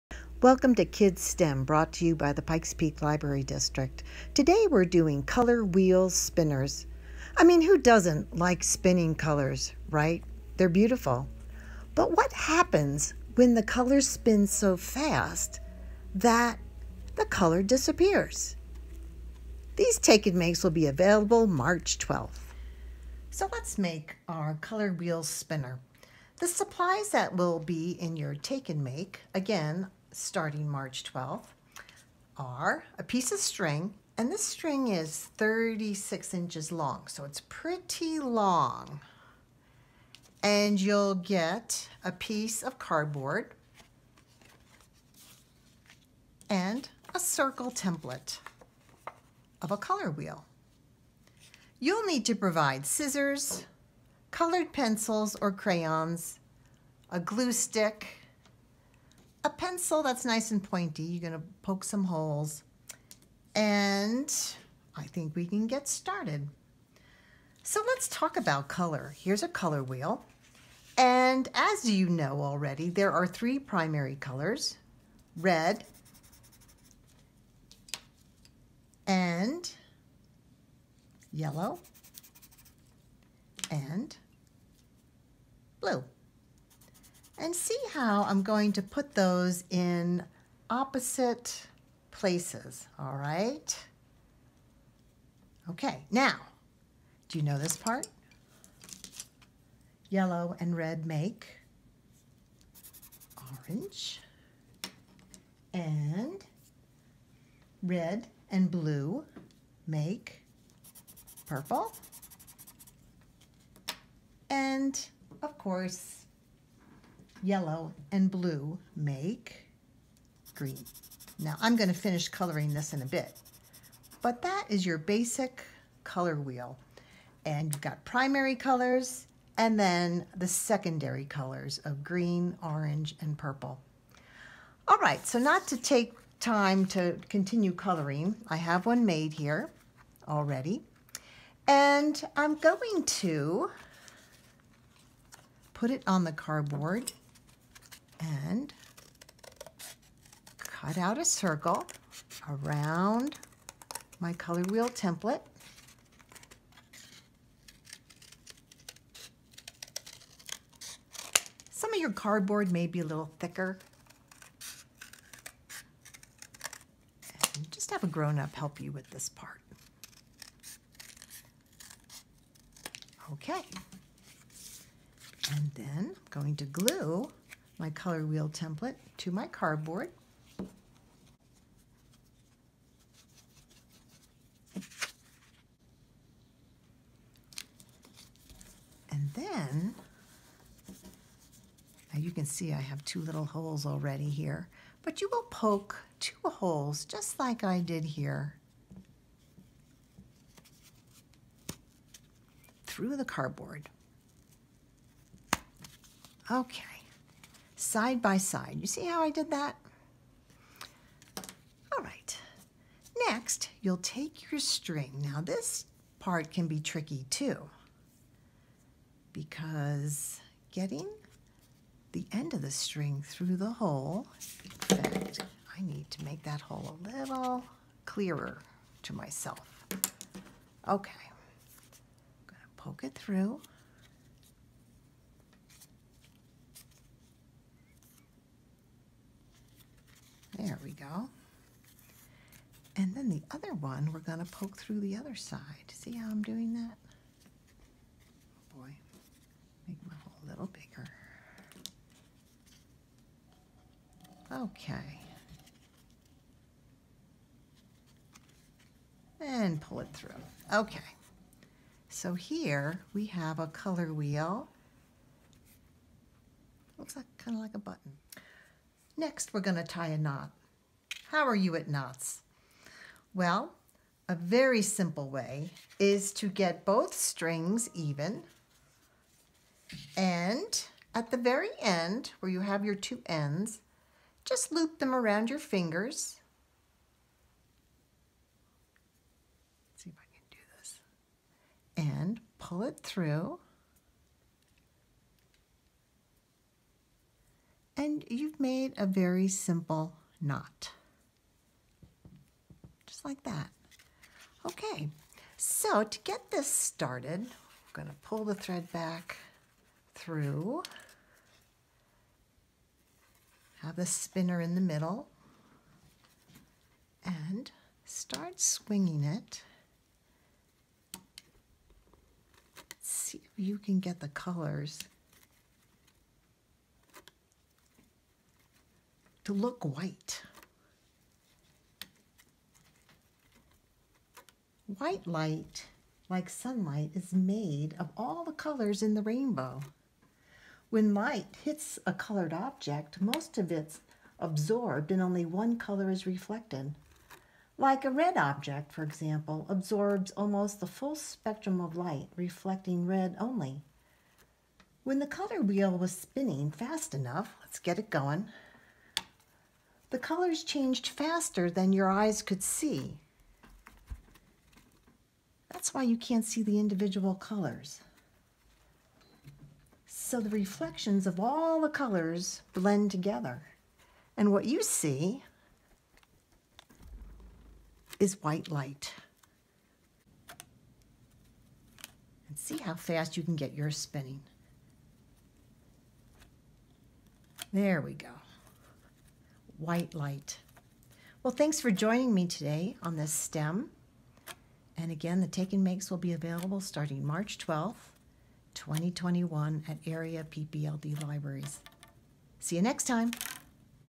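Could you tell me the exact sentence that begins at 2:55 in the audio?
And then I'm going to glue my color wheel template to my cardboard.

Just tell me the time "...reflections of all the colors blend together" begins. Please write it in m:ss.
6:10.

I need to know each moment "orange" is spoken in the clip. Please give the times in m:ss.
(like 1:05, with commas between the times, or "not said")
1:43, 2:12.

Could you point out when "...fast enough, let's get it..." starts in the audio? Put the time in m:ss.
5:56.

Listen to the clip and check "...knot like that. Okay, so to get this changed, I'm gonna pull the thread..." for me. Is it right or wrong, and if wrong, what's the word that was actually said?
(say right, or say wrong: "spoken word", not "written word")
wrong: "started", not "changed".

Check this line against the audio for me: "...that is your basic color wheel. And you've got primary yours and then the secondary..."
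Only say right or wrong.
wrong.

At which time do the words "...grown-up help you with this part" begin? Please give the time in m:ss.
2:48.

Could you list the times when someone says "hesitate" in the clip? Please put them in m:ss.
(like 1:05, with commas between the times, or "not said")
not said.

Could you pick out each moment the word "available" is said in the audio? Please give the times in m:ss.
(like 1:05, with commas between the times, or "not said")
0:20, 6:36.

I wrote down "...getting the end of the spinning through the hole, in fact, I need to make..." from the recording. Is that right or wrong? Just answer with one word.
wrong.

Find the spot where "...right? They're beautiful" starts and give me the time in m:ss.
0:09.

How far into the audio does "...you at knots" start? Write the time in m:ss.
4:31.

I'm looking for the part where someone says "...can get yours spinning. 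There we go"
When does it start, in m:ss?
6:23.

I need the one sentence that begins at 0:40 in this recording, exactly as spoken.
And you'll get a piece of cardboard and a circle template of a color wheel.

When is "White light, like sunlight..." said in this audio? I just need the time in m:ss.
5:34.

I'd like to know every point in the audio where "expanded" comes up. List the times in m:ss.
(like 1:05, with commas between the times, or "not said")
not said.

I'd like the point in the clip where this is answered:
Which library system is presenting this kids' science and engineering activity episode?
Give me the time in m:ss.
0:02.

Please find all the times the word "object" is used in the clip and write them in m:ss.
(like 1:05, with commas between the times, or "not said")
5:42, 5:48.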